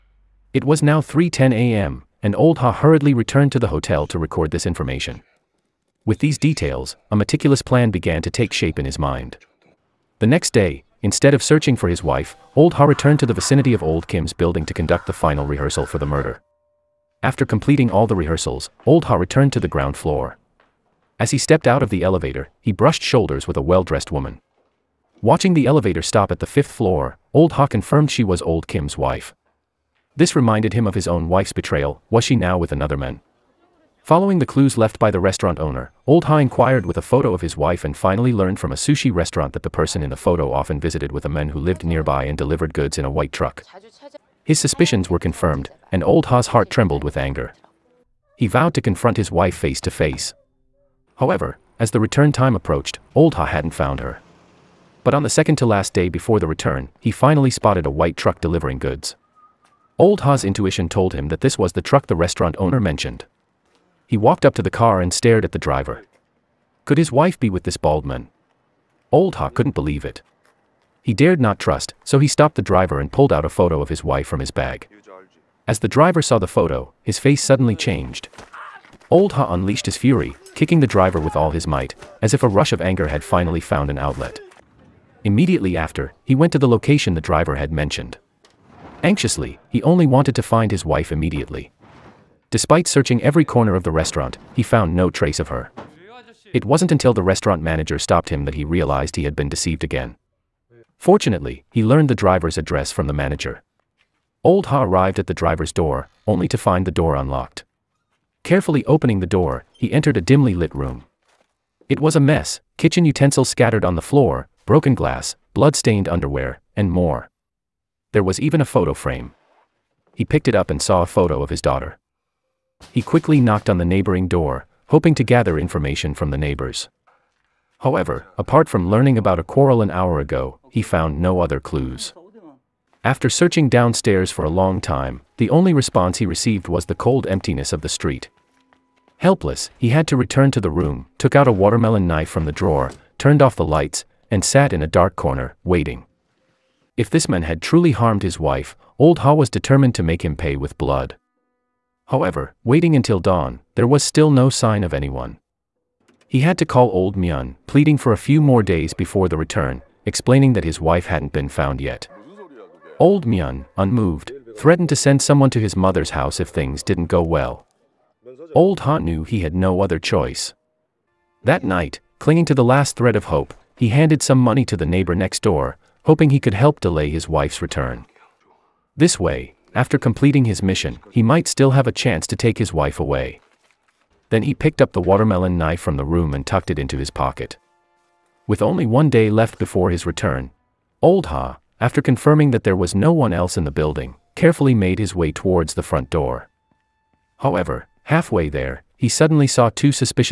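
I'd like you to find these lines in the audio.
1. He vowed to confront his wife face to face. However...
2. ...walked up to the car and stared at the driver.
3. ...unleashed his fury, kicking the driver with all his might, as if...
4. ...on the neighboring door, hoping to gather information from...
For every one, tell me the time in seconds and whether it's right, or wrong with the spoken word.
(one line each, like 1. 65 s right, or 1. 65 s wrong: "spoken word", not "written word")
1. 48 s right
2. 64 s right
3. 79 s right
4. 123 s right.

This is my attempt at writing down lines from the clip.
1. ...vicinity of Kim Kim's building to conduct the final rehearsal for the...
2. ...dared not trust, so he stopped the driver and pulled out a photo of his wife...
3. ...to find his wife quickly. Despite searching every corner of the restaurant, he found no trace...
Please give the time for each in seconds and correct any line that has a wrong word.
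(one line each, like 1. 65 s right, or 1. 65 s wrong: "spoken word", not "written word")
1. 13 s wrong: "Old", not "Kim"
2. 71 s right
3. 90 s wrong: "immediately", not "quickly".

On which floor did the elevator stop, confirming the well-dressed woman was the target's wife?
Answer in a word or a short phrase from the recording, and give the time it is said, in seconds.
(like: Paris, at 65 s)
fifth floor, at 26 s.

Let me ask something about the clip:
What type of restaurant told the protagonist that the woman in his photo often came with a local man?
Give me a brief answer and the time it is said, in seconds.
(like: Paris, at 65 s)
sushi restaurant, at 38 s.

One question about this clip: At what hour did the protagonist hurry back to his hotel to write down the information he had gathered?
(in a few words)
3:10 a.m.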